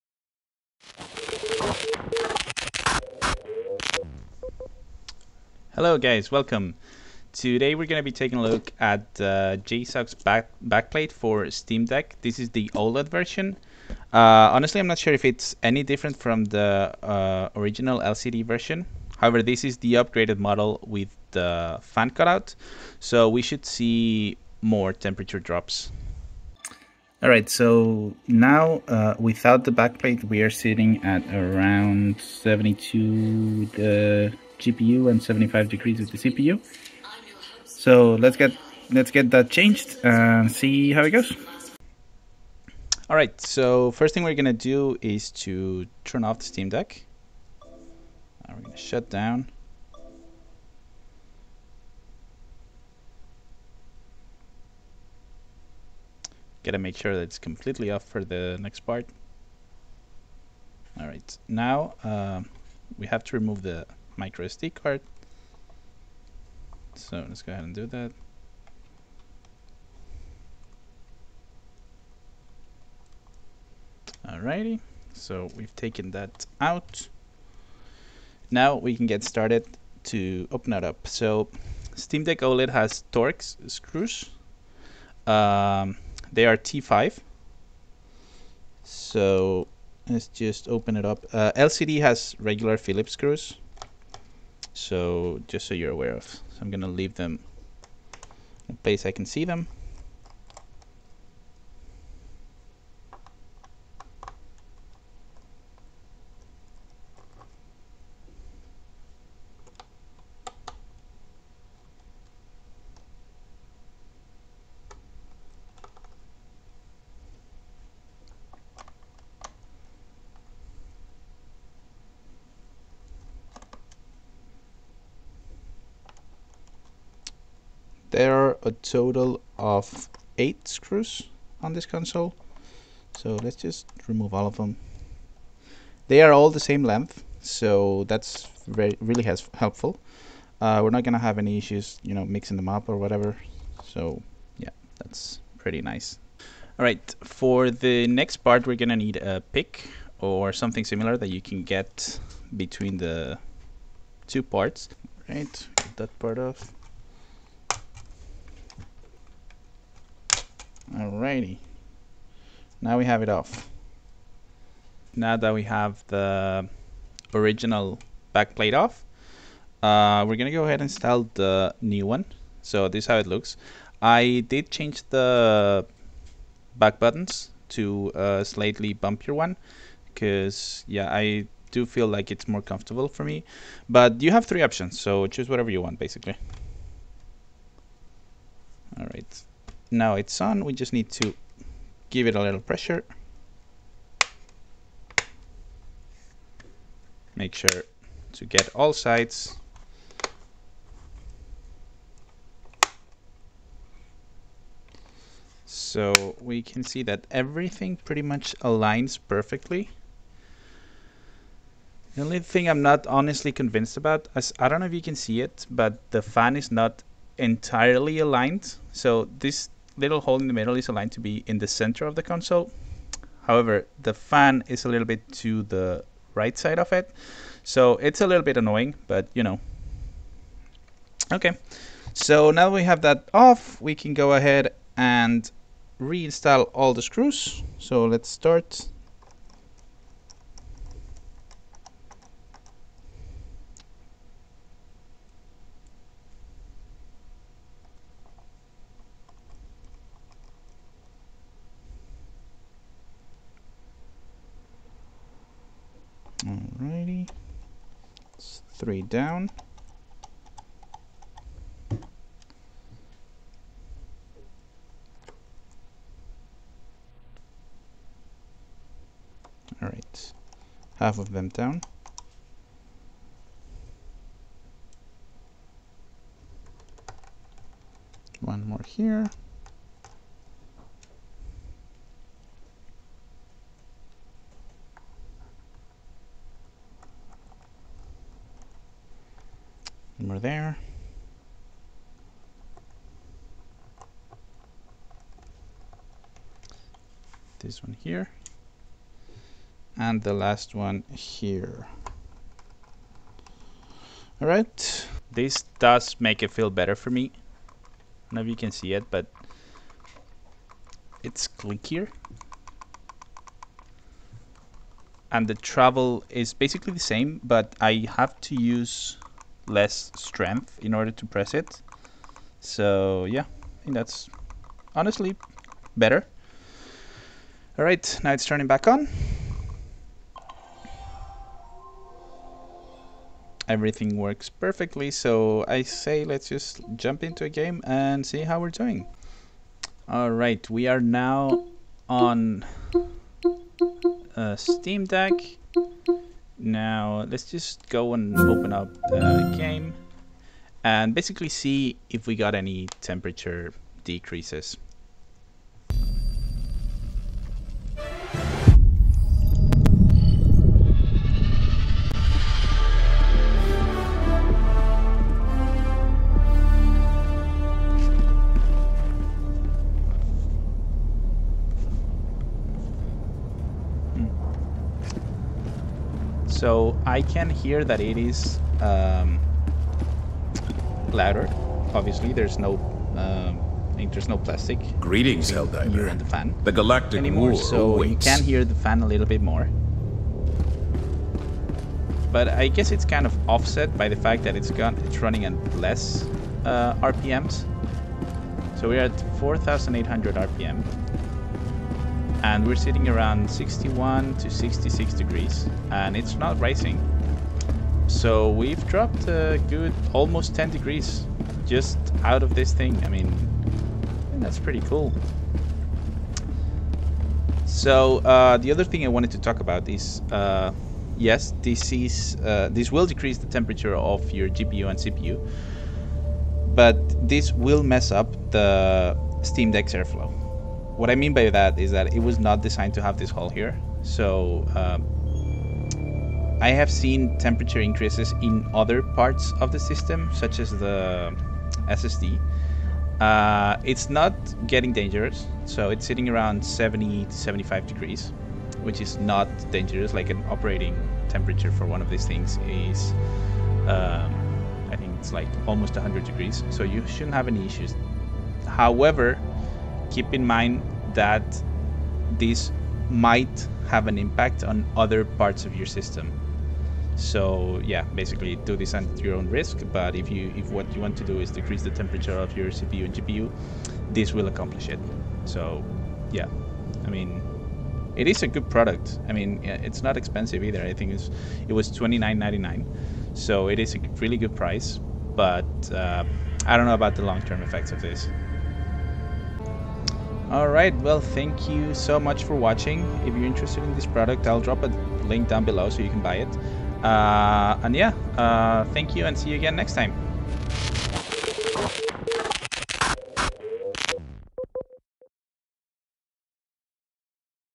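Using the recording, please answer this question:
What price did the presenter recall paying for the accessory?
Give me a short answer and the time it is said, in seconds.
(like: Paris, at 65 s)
$29.99, at 481 s.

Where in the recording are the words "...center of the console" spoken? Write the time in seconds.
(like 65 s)
221 s.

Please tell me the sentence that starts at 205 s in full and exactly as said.
So we can see that everything pretty much aligns perfectly.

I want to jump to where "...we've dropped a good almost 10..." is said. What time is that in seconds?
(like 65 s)
408 s.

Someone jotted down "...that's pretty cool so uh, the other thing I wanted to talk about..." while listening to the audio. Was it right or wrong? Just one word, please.
right.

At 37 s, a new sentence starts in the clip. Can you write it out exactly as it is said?
So let's get let's get that changed and see how it goes.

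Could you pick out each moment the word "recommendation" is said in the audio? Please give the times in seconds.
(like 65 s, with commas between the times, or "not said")
not said.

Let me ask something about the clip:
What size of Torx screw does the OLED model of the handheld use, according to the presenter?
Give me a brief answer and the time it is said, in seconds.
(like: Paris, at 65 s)
T5, at 86 s.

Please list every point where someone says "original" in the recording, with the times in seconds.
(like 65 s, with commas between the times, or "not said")
17 s, 167 s.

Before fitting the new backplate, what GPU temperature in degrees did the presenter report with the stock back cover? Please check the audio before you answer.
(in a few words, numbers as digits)
72.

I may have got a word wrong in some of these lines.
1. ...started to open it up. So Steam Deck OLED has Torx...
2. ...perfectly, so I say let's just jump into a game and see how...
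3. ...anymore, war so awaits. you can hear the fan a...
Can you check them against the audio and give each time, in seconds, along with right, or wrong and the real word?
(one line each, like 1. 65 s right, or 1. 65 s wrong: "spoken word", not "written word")
1. 79 s right
2. 334 s right
3. 387 s right.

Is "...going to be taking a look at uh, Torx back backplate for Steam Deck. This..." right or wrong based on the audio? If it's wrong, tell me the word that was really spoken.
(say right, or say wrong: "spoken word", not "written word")
wrong: "JSAUX", not "Torx".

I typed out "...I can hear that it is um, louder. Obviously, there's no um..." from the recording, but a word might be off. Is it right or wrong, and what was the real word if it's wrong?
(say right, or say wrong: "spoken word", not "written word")
right.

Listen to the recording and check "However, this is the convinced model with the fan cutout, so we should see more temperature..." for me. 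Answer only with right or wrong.
wrong.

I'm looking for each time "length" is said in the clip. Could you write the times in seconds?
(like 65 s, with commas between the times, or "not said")
136 s.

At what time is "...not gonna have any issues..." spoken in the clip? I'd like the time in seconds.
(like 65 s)
140 s.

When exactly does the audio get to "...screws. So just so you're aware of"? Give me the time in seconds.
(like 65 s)
93 s.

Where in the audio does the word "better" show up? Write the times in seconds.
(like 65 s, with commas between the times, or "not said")
306 s, 325 s.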